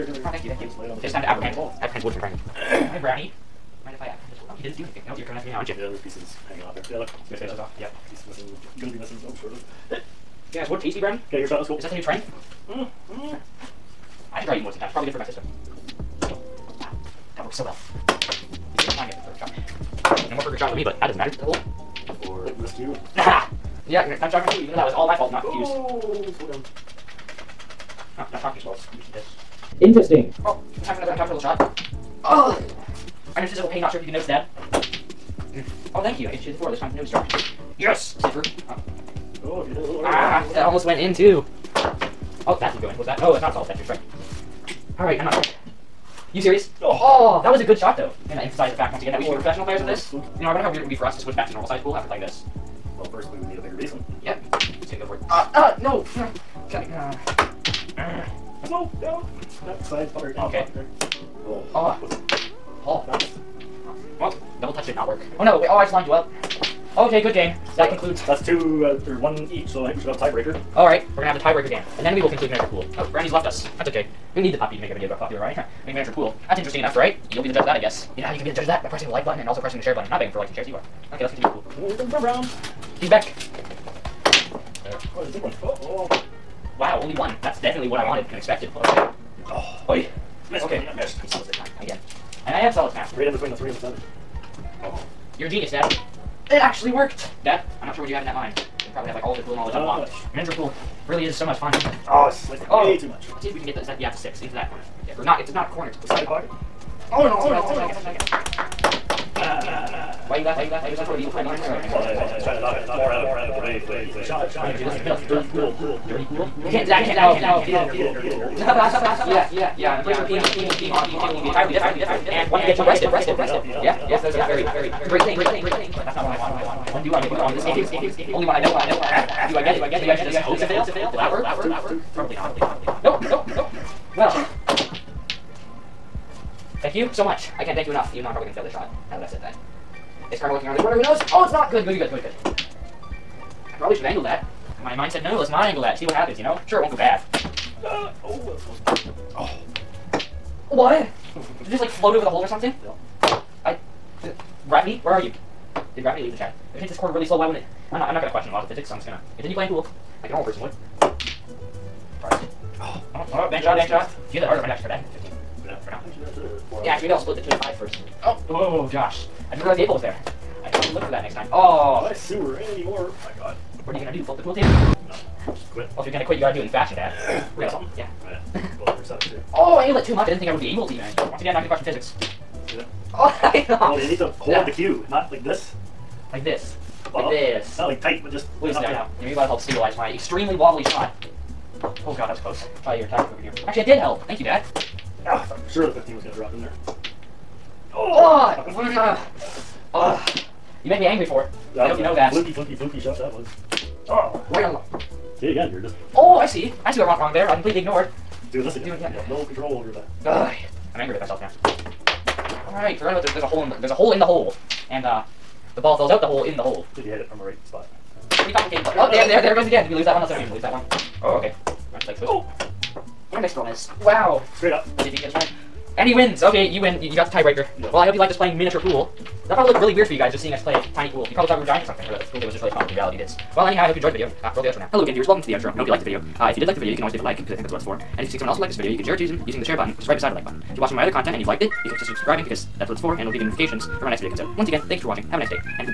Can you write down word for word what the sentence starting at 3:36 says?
Should you hit it from the right spot.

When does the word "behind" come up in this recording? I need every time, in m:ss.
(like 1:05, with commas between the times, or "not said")
1:51.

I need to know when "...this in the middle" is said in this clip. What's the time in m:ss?
1:54.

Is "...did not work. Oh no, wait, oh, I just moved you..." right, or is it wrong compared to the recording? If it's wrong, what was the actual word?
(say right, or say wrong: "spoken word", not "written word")
wrong: "lined", not "moved".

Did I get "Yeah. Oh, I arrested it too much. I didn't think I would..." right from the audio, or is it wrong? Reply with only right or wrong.
wrong.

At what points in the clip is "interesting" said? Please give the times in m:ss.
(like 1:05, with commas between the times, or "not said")
0:29, 1:16.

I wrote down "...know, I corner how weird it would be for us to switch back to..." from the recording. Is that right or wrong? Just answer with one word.
wrong.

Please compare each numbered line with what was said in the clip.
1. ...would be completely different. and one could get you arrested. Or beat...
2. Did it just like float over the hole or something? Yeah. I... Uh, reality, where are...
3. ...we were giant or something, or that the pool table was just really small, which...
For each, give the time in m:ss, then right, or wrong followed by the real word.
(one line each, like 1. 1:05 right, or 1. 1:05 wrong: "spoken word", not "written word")
1. 2:01 wrong: "entirely", not "completely"
2. 2:31 wrong: "gravity", not "reality"
3. 3:51 right.